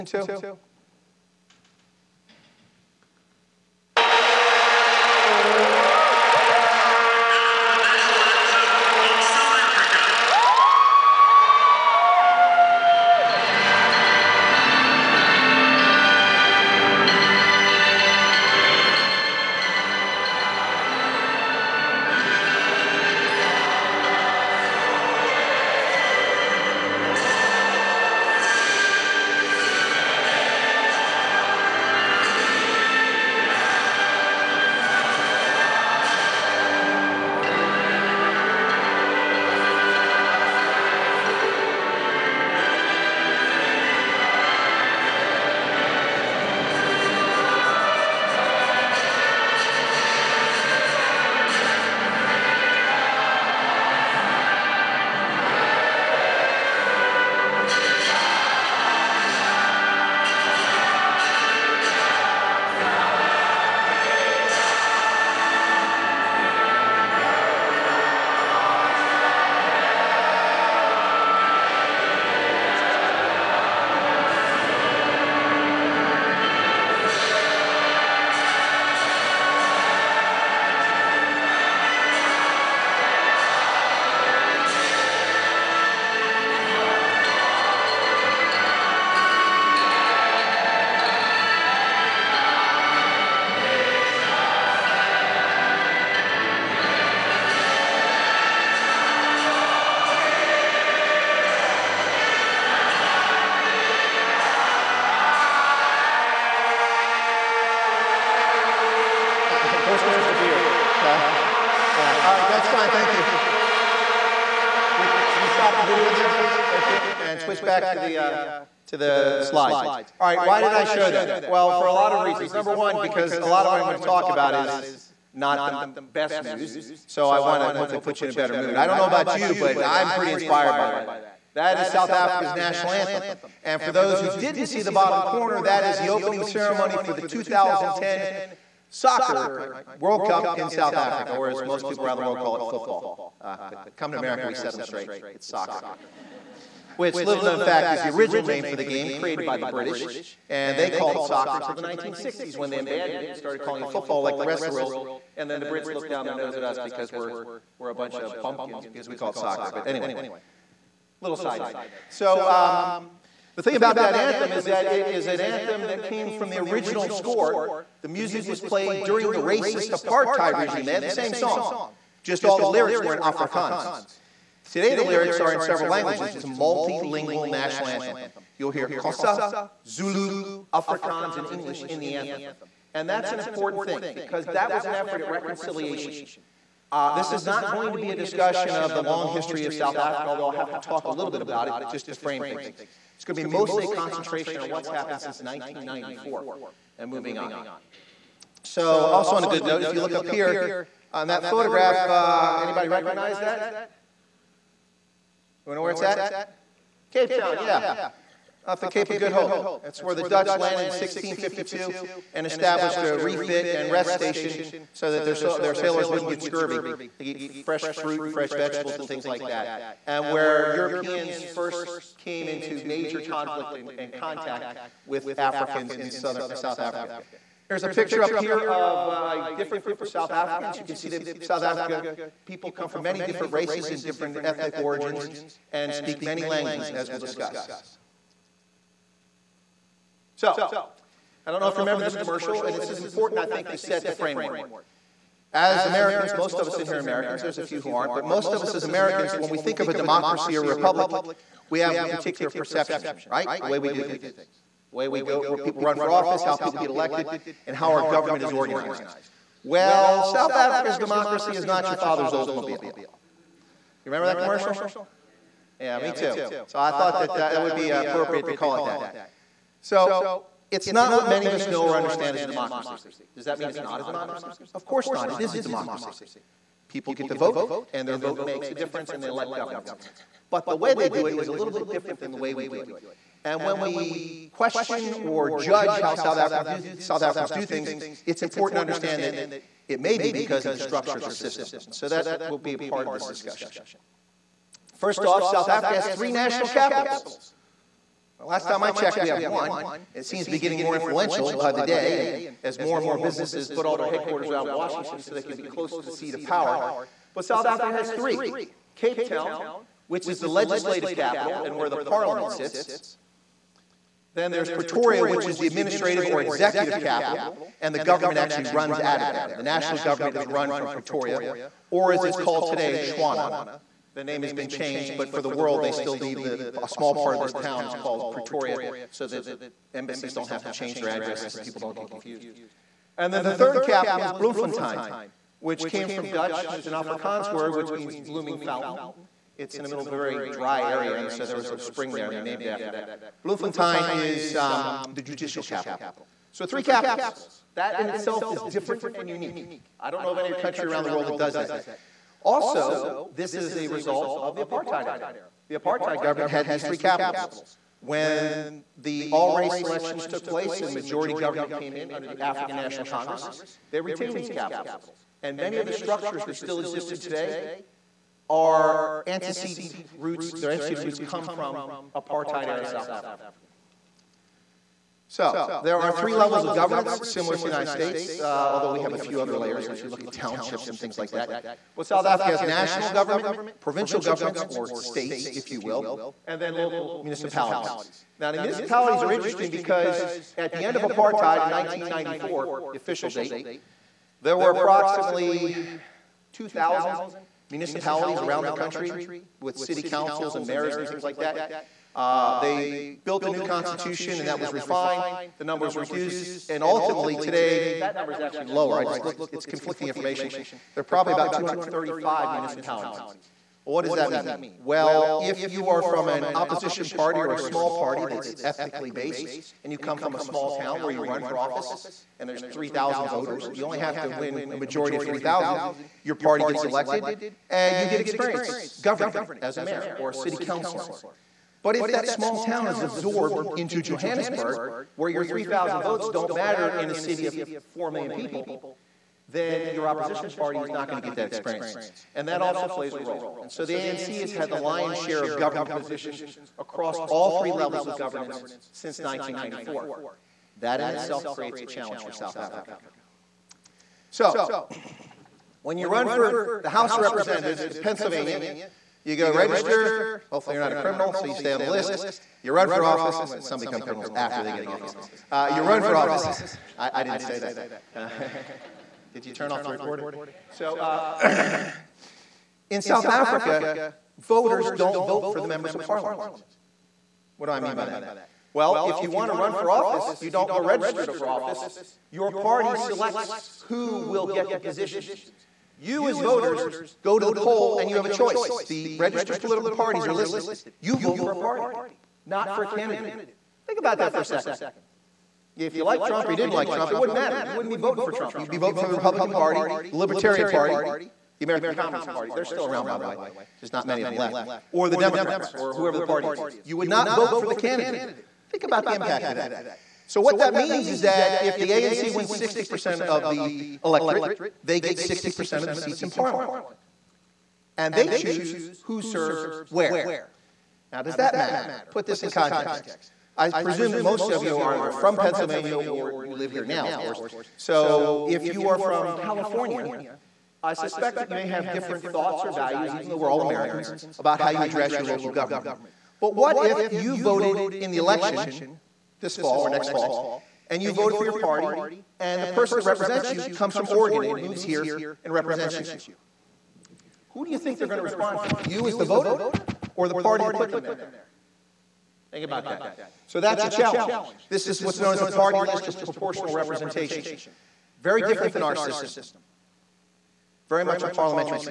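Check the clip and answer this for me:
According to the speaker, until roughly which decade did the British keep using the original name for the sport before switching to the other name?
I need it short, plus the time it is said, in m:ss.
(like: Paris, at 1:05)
1960s, at 2:31.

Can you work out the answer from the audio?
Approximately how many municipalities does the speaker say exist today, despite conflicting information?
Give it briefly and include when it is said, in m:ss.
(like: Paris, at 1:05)
235, at 6:51.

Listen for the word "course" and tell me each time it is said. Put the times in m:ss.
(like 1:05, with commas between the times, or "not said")
4:34, 8:47.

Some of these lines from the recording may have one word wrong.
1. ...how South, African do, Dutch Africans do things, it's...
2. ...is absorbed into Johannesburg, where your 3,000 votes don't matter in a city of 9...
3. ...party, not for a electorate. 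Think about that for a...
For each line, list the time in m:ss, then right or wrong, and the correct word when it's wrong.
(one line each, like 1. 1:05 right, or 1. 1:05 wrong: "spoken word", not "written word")
1. 4:46 wrong: "South", not "Dutch"
2. 7:12 wrong: "4", not "9"
3. 8:11 wrong: "candidate", not "electorate".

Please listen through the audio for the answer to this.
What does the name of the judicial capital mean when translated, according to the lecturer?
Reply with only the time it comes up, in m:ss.
5:38.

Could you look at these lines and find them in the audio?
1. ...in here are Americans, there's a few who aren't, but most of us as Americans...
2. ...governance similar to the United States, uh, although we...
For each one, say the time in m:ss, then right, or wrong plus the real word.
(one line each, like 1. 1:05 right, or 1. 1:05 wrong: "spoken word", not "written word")
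1. 4:06 right
2. 6:16 right.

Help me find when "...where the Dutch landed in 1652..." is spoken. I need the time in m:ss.
3:30.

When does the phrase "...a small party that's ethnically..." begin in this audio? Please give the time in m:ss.
6:57.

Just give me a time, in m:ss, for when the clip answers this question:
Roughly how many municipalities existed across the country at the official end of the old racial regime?
6:36.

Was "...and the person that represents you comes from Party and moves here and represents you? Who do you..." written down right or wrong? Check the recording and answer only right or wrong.
wrong.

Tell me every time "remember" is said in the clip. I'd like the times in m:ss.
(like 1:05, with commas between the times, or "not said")
4:01, 4:24.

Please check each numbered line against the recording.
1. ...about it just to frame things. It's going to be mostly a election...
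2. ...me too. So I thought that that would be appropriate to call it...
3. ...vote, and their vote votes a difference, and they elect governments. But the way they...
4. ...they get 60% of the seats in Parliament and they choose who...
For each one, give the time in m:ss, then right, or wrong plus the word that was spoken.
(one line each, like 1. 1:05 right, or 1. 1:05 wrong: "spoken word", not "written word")
1. 3:11 wrong: "concentration", not "election"
2. 4:25 right
3. 4:37 wrong: "makes", not "votes"
4. 8:34 right.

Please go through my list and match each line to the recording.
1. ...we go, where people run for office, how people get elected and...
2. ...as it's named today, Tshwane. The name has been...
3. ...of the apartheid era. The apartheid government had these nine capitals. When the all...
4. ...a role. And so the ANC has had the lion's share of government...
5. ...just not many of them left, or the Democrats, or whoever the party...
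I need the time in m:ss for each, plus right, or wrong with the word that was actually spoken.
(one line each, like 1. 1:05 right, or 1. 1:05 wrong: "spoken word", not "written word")
1. 4:15 right
2. 5:22 wrong: "called", not "named"
3. 5:54 wrong: "three", not "nine"
4. 7:23 right
5. 8:23 right.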